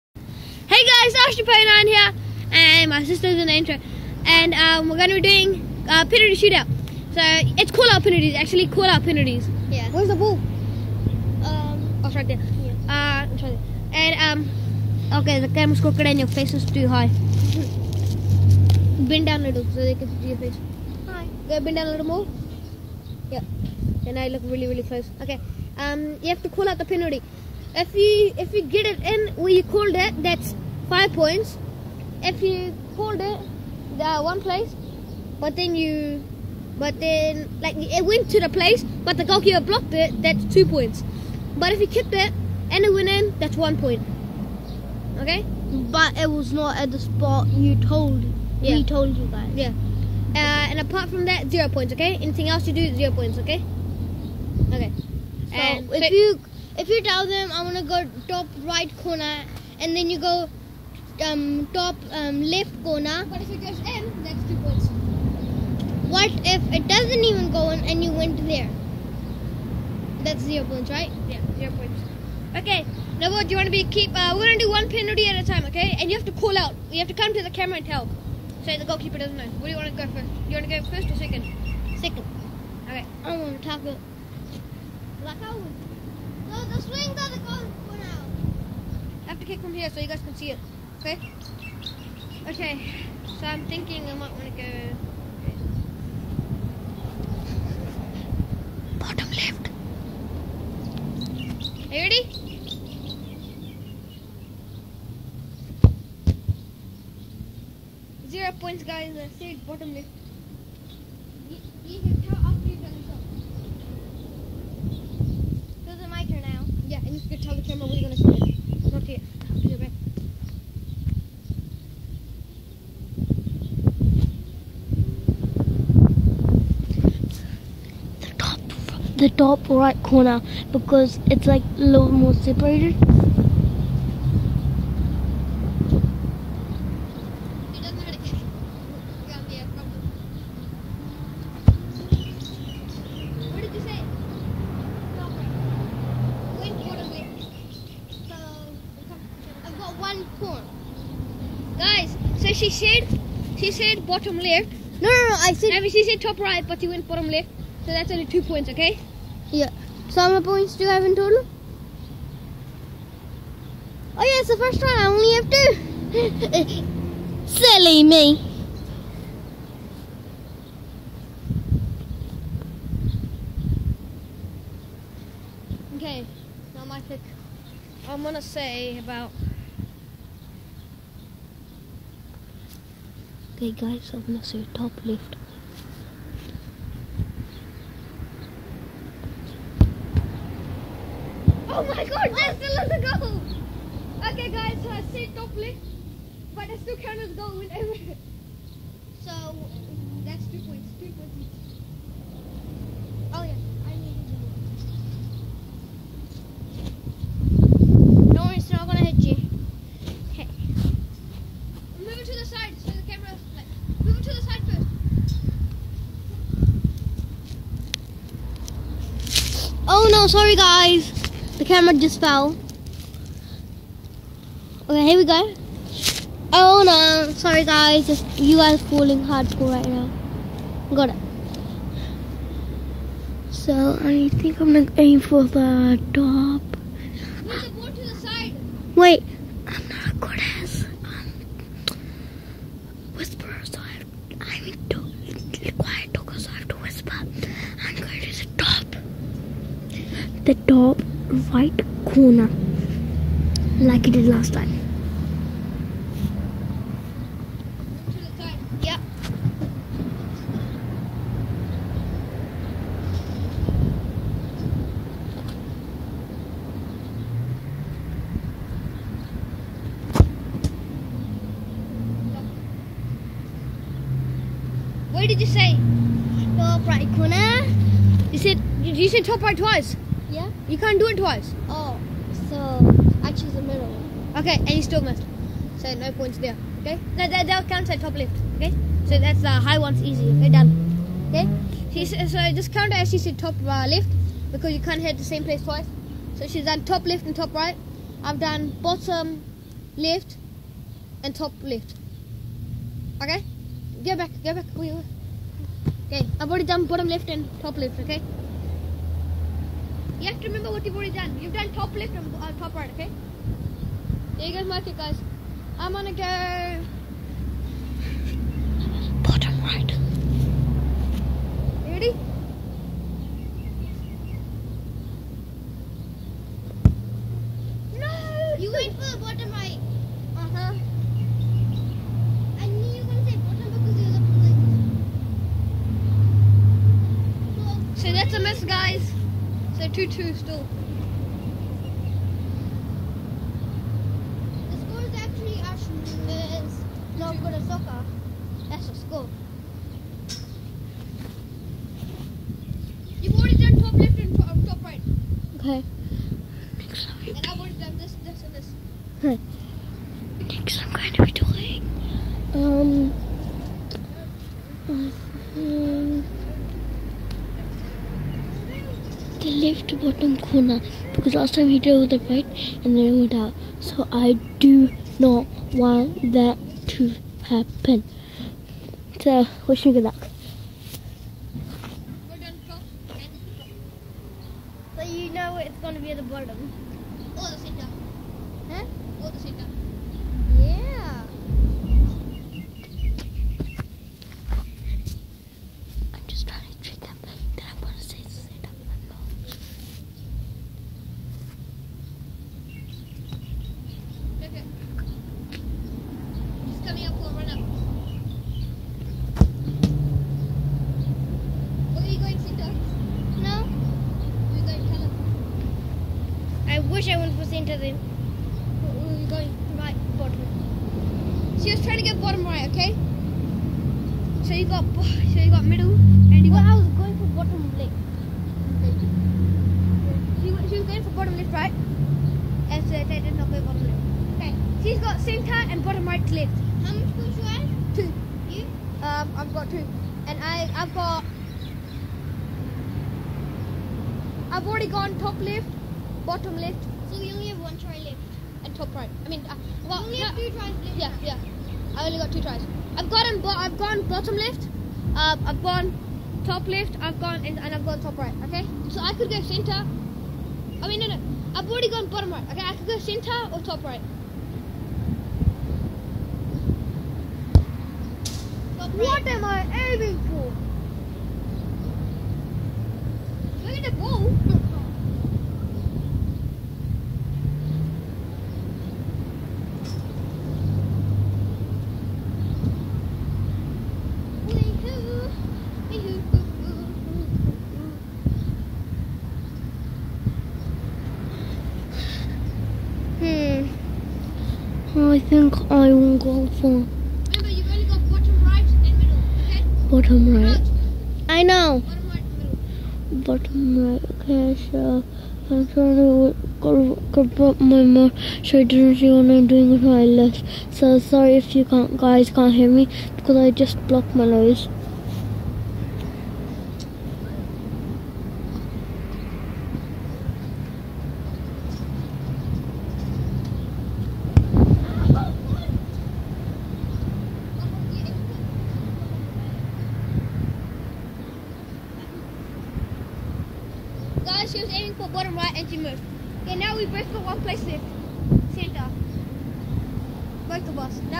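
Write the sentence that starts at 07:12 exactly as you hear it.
And so they did not go bottom left.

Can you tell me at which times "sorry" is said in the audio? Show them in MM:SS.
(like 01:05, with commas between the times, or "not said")
03:40, 03:47, 08:30.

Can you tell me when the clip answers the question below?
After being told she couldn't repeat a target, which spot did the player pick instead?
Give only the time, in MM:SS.
04:43.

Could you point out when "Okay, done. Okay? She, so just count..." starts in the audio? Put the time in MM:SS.
04:50.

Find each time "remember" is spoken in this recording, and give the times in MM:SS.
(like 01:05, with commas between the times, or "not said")
05:10.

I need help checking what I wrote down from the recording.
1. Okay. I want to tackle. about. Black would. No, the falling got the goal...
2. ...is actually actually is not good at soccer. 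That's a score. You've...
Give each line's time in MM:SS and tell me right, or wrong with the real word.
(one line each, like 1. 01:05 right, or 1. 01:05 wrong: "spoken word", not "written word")
1. 01:22 wrong: "swing", not "falling"
2. 05:45 right.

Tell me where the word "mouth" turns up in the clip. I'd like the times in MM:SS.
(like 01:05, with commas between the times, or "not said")
08:27.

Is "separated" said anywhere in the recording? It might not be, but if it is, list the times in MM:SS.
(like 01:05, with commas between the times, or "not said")
02:12.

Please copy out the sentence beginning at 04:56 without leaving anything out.
So she's done top left and top right.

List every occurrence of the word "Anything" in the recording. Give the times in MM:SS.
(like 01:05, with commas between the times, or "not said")
00:52.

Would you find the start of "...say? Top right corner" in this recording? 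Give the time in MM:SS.
04:35.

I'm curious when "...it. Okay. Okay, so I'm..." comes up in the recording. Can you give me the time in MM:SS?
01:30.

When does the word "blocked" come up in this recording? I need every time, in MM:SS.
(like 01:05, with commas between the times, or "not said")
00:39, 08:33.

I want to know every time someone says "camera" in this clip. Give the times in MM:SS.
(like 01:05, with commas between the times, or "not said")
00:15, 01:17, 03:33, 03:41.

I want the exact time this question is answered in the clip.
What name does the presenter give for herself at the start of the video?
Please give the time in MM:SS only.
00:01.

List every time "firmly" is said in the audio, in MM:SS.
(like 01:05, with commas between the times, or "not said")
not said.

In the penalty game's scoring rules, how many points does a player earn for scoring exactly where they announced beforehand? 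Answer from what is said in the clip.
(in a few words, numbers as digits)
5.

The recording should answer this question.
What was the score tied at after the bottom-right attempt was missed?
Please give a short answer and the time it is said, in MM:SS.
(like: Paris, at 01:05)
2 2, at 05:39.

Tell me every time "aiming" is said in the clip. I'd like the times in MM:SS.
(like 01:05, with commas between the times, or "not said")
07:49, 08:54.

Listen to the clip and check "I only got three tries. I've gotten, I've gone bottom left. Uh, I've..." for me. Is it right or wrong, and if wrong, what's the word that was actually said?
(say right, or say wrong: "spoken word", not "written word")
wrong: "two", not "three".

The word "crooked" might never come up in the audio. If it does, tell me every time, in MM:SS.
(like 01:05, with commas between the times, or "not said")
00:15.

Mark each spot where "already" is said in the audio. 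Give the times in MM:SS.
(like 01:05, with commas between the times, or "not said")
05:06, 05:10, 05:53, 05:57, 07:24, 07:41.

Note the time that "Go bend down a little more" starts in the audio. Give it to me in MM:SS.
00:21.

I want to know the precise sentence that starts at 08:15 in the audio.
I think I will go for bottom right, middle, okay?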